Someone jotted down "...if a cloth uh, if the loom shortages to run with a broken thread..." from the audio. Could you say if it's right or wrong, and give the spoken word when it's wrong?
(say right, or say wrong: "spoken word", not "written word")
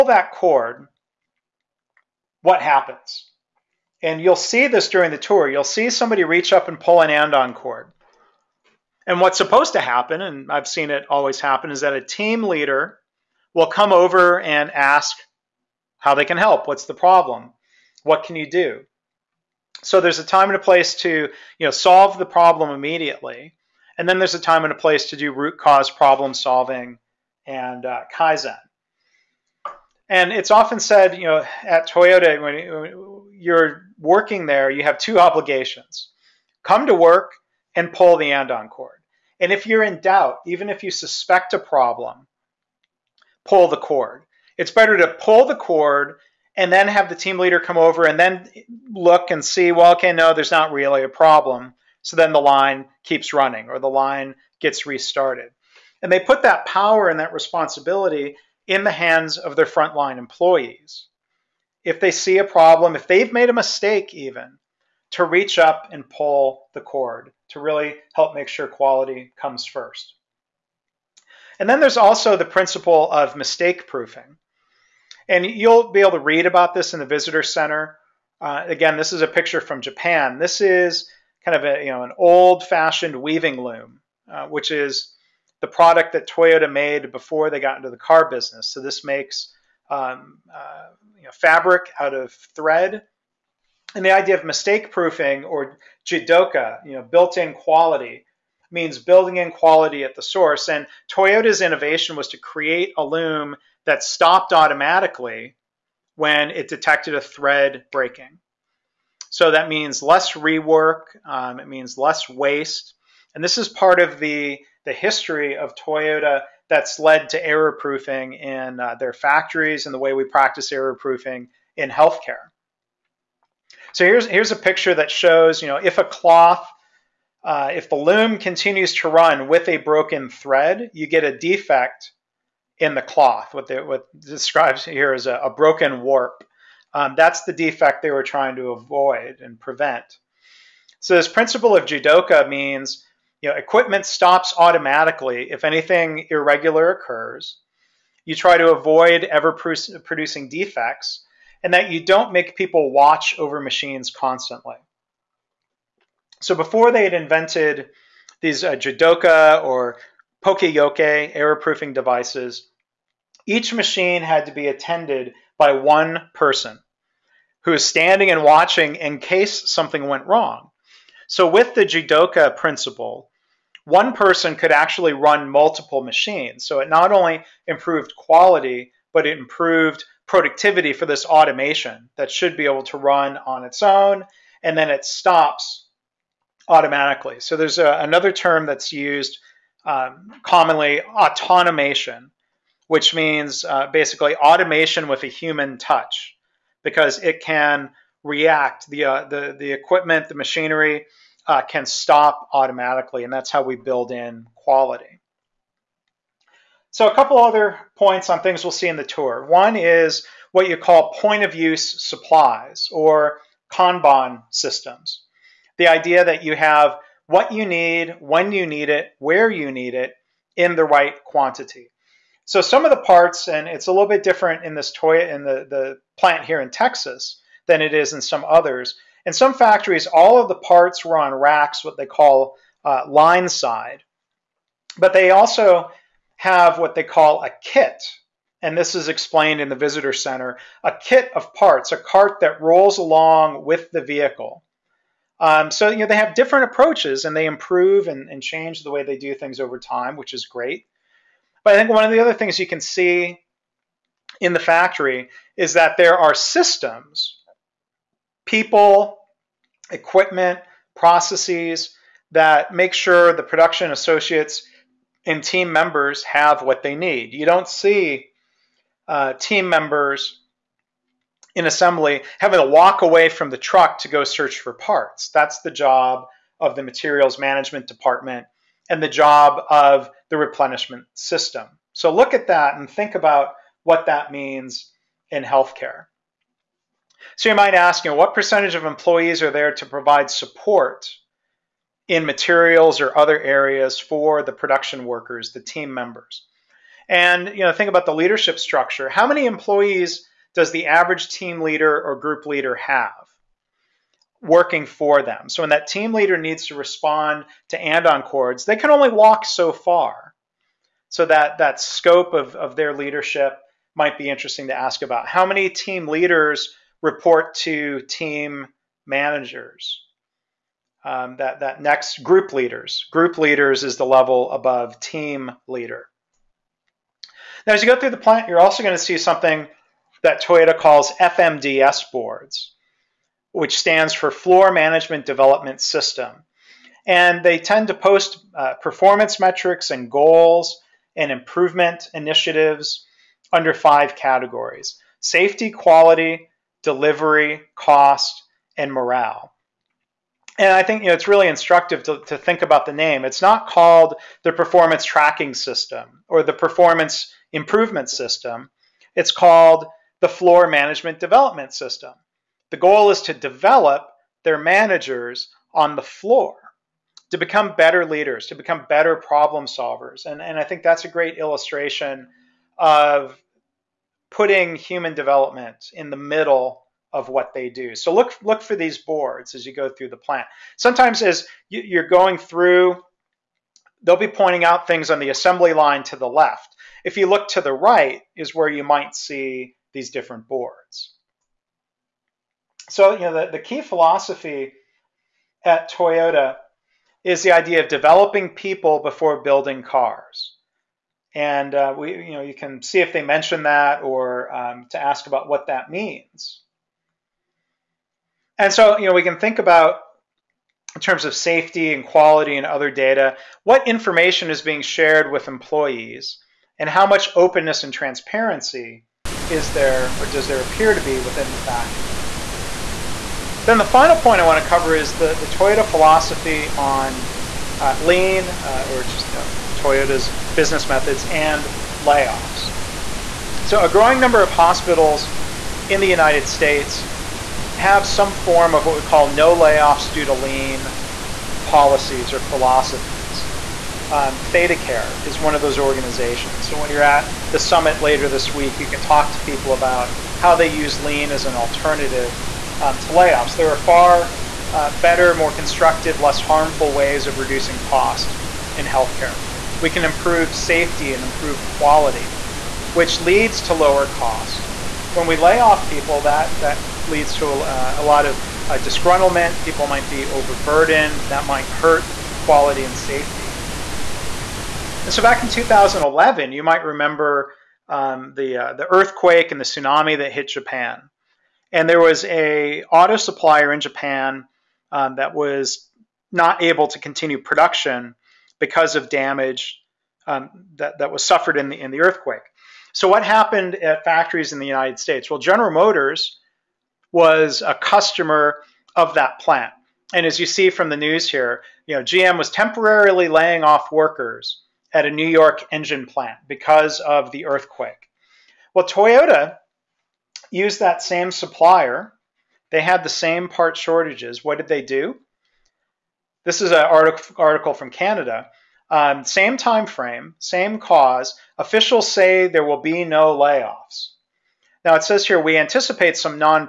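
wrong: "continues", not "shortages".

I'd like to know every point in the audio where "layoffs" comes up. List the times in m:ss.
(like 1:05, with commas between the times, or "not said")
7:12, 7:19, 7:33, 8:43.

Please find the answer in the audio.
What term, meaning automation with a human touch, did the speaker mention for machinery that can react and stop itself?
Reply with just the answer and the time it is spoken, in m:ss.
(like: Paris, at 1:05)
autonomation, at 3:11.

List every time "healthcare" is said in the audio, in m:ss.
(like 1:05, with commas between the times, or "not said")
2:01, 4:45, 7:38.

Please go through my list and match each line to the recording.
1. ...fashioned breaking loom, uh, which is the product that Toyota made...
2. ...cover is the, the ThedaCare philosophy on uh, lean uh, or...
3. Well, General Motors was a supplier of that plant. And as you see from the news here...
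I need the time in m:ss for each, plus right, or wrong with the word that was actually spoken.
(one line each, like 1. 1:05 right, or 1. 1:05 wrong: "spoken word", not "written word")
1. 1:22 wrong: "weaving", not "breaking"
2. 7:04 wrong: "Toyota", not "ThedaCare"
3. 8:15 wrong: "customer", not "supplier".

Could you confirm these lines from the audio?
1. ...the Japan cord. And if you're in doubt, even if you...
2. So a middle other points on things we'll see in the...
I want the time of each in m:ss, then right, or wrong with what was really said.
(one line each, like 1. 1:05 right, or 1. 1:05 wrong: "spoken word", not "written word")
1. 0:38 wrong: "Andon", not "Japan"
2. 3:26 wrong: "couple", not "middle".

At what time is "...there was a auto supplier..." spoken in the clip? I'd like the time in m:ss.
8:01.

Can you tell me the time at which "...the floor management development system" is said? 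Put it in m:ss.
6:00.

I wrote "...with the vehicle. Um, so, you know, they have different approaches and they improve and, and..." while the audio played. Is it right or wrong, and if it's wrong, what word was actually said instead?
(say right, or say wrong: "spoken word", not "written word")
right.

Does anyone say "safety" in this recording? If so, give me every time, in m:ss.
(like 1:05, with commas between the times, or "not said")
5:45, 6:51, 7:40, 7:52.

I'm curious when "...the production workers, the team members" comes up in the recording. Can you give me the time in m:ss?
4:54.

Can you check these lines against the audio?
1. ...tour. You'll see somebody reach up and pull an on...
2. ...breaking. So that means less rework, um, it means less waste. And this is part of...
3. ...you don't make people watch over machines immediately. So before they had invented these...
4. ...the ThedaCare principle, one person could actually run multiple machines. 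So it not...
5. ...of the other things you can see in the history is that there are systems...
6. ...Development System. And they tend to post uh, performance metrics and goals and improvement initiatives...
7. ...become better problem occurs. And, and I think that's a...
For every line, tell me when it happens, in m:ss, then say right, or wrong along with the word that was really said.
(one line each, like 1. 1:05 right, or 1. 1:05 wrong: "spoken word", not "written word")
1. 0:05 right
2. 1:47 right
3. 2:31 wrong: "constantly", not "immediately"
4. 2:51 wrong: "Jidoka", not "ThedaCare"
5. 4:12 wrong: "factory", not "history"
6. 5:35 right
7. 6:08 wrong: "solvers", not "occurs".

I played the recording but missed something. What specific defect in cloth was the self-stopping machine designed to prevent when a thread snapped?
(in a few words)
broken warp.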